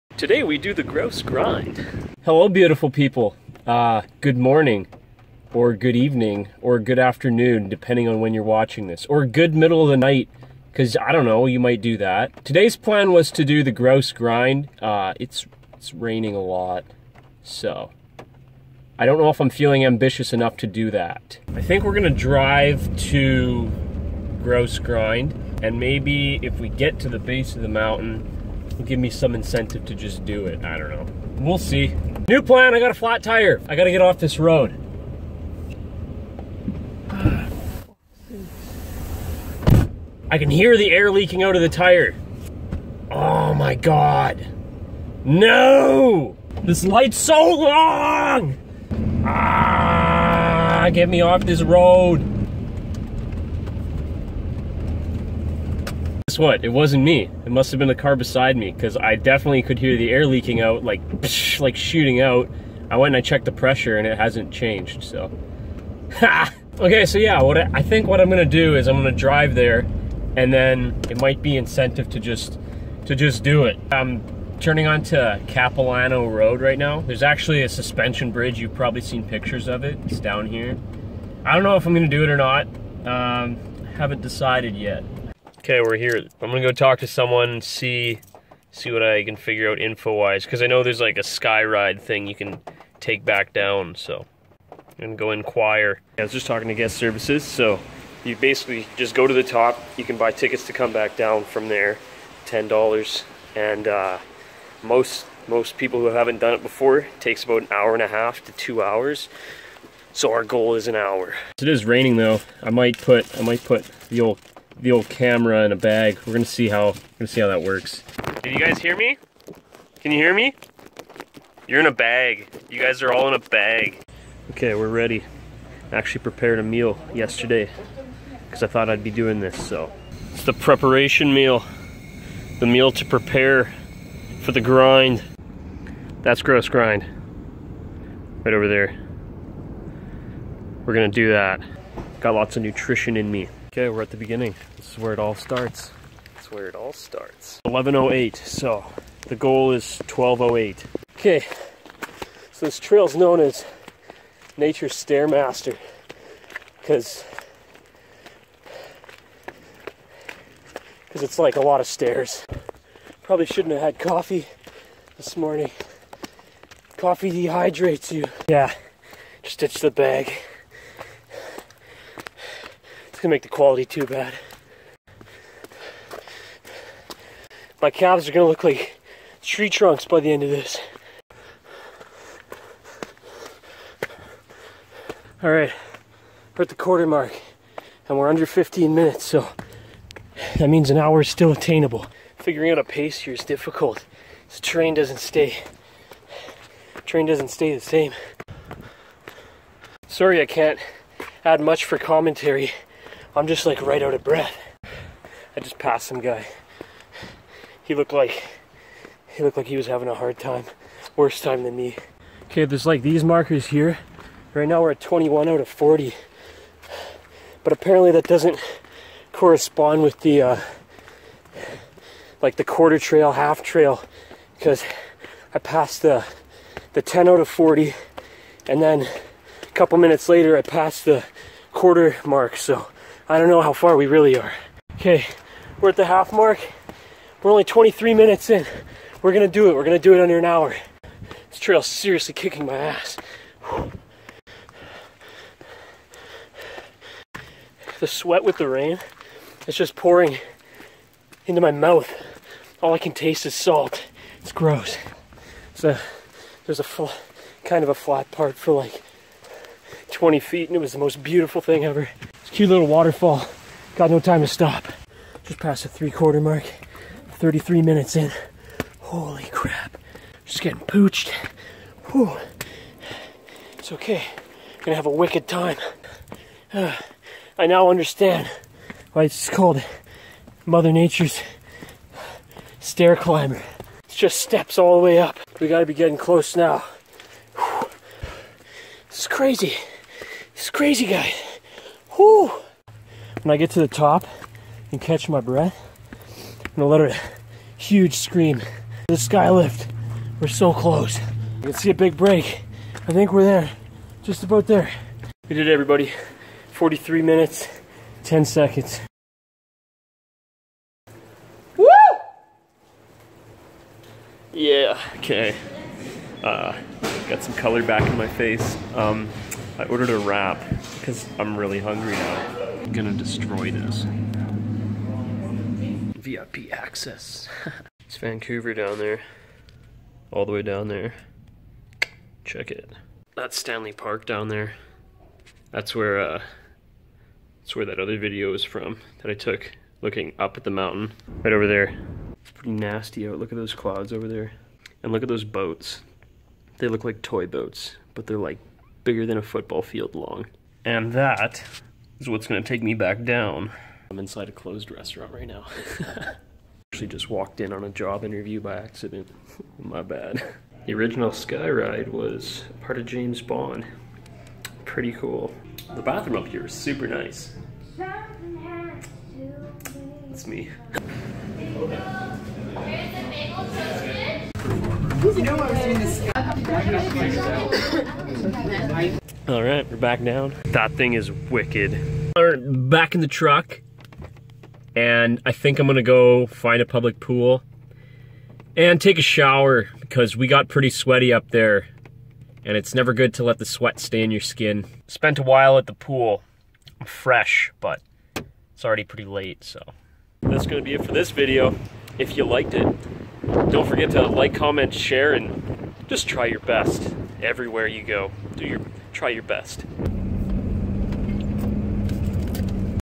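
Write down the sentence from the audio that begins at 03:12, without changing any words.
Figuring out a pace here is difficult.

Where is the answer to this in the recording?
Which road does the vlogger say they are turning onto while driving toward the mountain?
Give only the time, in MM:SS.
01:15.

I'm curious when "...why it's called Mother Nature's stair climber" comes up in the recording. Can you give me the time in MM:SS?
04:39.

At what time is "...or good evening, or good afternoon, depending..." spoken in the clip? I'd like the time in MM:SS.
00:05.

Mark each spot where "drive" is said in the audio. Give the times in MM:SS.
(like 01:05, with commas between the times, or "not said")
00:22, 01:09.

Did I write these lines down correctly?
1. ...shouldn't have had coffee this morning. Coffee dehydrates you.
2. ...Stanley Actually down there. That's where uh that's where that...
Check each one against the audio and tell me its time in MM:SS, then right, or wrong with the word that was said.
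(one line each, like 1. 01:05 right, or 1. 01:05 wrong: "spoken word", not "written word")
1. 02:43 right
2. 05:33 wrong: "Park", not "Actually".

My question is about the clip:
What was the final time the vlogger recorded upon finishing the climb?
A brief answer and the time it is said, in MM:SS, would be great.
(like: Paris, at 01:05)
43 minutes, 10 seconds, at 05:06.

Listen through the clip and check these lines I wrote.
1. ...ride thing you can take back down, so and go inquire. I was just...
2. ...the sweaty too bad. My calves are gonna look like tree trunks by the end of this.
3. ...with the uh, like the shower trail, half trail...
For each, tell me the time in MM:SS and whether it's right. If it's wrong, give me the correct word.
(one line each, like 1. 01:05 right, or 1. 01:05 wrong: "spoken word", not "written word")
1. 01:31 right
2. 02:53 wrong: "quality", not "sweaty"
3. 03:40 wrong: "quarter", not "shower".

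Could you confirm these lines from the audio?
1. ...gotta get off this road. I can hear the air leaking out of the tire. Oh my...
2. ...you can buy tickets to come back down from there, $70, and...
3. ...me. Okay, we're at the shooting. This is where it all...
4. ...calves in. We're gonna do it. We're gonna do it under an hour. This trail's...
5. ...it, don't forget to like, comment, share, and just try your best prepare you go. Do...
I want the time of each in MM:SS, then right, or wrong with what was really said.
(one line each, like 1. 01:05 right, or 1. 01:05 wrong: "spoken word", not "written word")
1. 00:33 right
2. 01:39 wrong: "10", not "70"
3. 02:23 wrong: "beginning", not "shooting"
4. 03:58 wrong: "minutes", not "calves"
5. 06:42 wrong: "everywhere", not "prepare".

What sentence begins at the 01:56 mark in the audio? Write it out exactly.
We're gonna see how gonna see how that works.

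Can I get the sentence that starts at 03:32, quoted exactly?
Okay, there's like these markers here.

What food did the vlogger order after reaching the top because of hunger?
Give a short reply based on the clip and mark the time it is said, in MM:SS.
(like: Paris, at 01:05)
A wrap, at 05:20.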